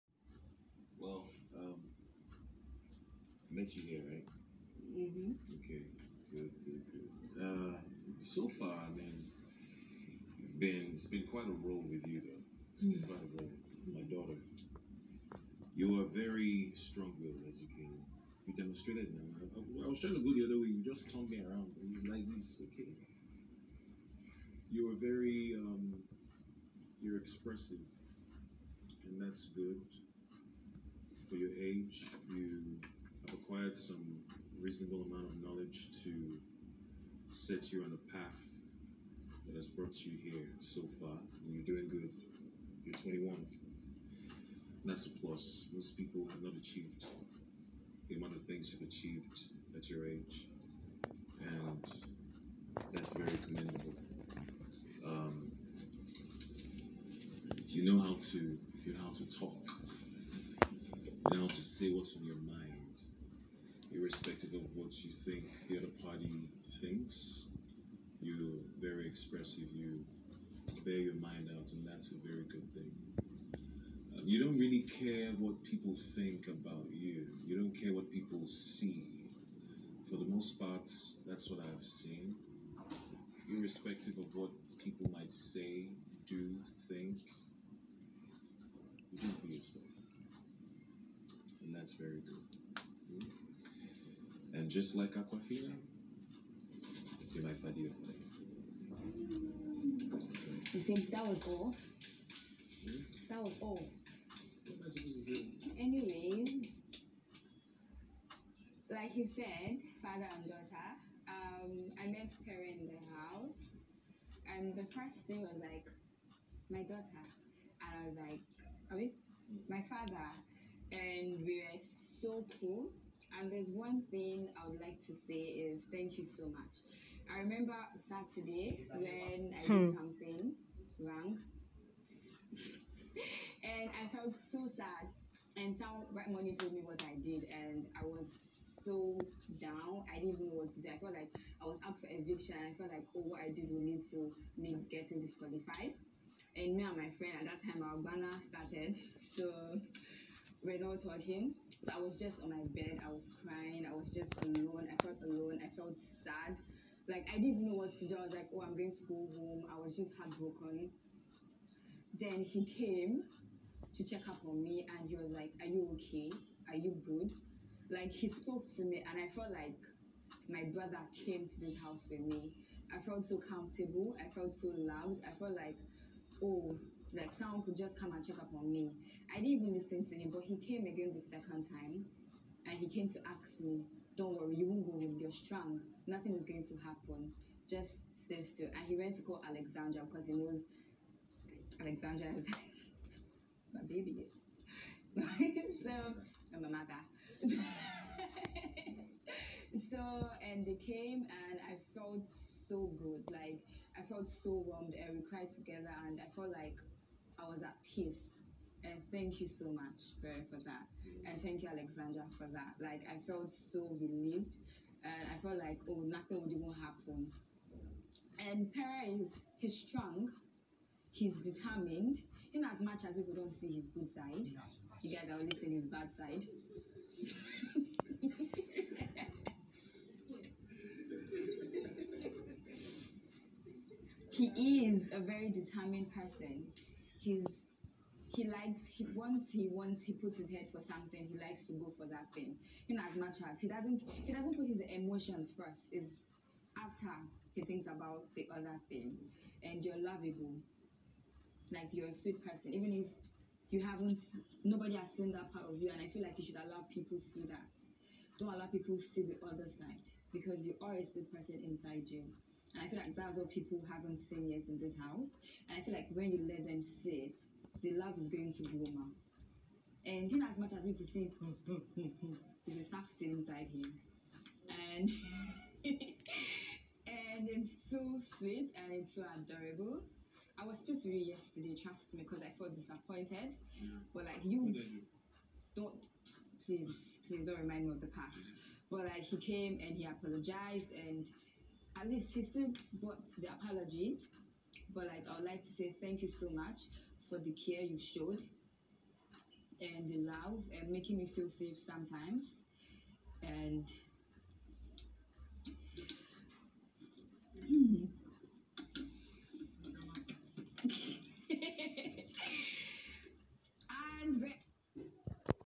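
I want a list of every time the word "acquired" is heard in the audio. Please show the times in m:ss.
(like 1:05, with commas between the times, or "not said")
0:33.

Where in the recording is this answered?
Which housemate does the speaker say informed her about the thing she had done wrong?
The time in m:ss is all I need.
2:16.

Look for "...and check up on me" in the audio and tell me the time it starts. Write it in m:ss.
2:58.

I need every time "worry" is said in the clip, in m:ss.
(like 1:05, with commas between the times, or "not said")
3:04.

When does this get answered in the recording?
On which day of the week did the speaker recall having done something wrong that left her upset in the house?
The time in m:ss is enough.
2:08.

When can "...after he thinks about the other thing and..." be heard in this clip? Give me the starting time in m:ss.
4:06.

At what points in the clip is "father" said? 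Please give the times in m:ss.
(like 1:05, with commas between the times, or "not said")
1:50, 1:59.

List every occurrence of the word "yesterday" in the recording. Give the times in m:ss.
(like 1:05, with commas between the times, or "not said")
4:41.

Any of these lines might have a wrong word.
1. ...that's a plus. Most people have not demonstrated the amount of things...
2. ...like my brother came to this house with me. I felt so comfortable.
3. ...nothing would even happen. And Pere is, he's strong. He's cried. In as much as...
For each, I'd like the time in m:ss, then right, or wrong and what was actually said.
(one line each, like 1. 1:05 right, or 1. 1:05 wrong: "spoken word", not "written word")
1. 0:44 wrong: "achieved", not "demonstrated"
2. 2:49 right
3. 3:36 wrong: "determined", not "cried".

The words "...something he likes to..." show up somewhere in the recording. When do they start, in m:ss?
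4:00.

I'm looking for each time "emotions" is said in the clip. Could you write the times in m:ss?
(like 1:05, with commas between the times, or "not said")
4:04.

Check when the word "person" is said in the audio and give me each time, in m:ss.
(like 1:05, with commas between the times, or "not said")
3:56, 4:12, 4:21.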